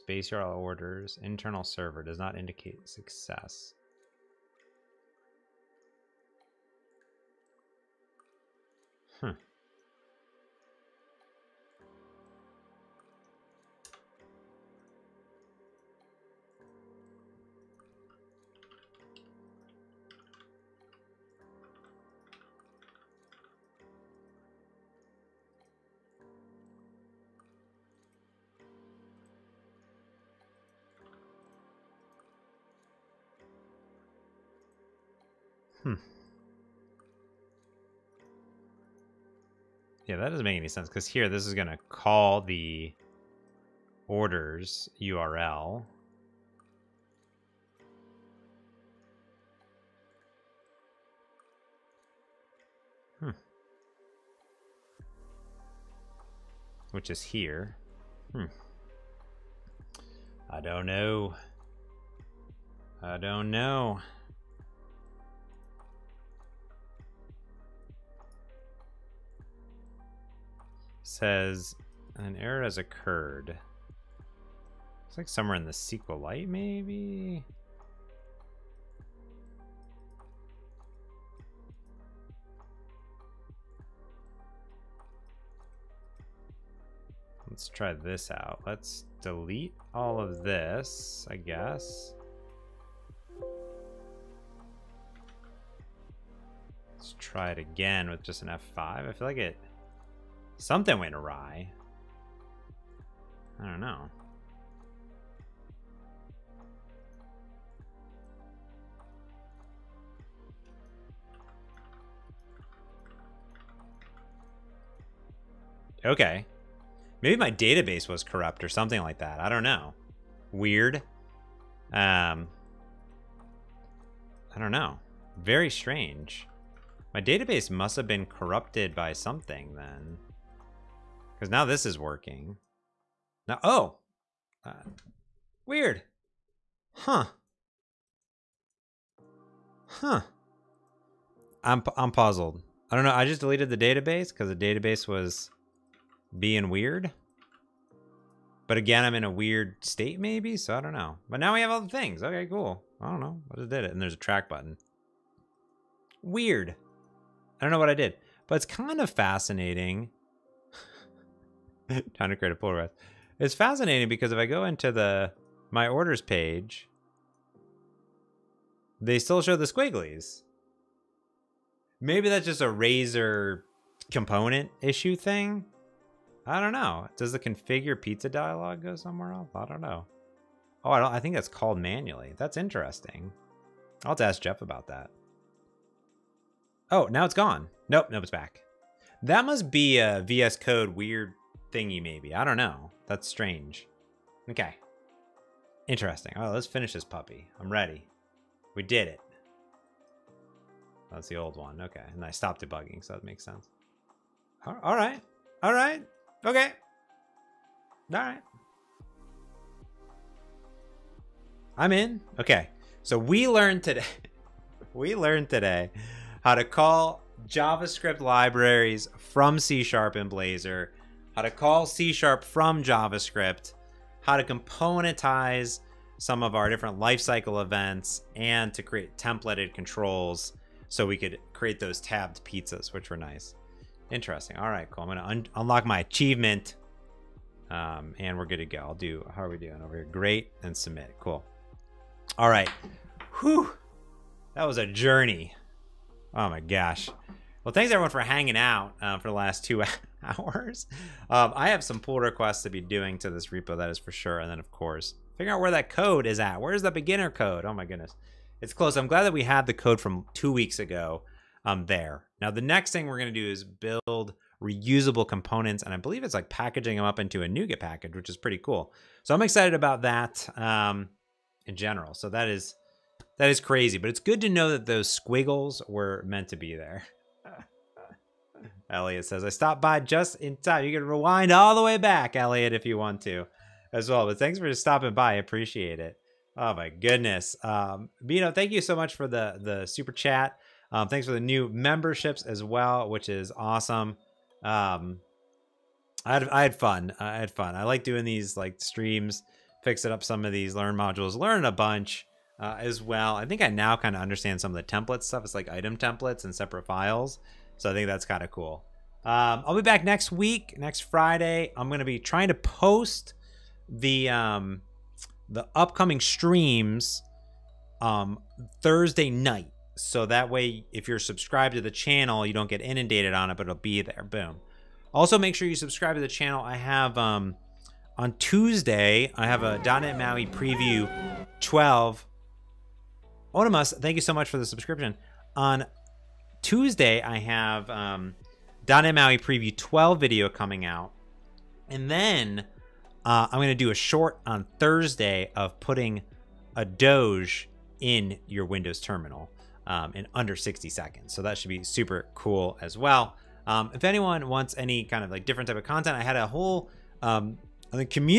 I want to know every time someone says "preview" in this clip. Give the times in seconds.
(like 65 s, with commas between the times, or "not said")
330 s, 339 s.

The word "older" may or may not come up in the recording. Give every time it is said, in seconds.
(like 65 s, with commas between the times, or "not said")
not said.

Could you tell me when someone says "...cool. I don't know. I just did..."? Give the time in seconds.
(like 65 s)
152 s.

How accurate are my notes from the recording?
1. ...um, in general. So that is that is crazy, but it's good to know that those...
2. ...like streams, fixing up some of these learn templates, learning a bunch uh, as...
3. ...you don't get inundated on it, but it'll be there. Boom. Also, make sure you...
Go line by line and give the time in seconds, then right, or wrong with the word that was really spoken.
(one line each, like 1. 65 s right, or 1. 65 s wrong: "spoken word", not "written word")
1. 270 s right
2. 298 s wrong: "modules", not "templates"
3. 322 s right.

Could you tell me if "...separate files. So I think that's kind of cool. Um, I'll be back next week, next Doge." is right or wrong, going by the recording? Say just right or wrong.
wrong.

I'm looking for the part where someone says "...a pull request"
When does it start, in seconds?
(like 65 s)
162 s.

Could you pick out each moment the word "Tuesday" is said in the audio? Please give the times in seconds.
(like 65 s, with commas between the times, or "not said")
328 s, 336 s.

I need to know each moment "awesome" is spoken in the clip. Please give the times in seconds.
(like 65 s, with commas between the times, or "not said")
293 s.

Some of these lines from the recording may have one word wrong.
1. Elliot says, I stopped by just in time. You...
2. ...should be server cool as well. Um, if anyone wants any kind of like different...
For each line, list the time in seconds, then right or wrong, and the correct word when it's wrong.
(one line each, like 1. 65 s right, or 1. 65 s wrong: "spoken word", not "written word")
1. 278 s right
2. 351 s wrong: "super", not "server".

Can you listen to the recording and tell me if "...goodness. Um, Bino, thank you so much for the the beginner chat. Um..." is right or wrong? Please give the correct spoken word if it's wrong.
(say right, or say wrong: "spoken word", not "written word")
wrong: "super", not "beginner".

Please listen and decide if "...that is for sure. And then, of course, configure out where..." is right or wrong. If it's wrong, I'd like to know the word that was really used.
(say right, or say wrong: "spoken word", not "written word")
wrong: "figure", not "configure".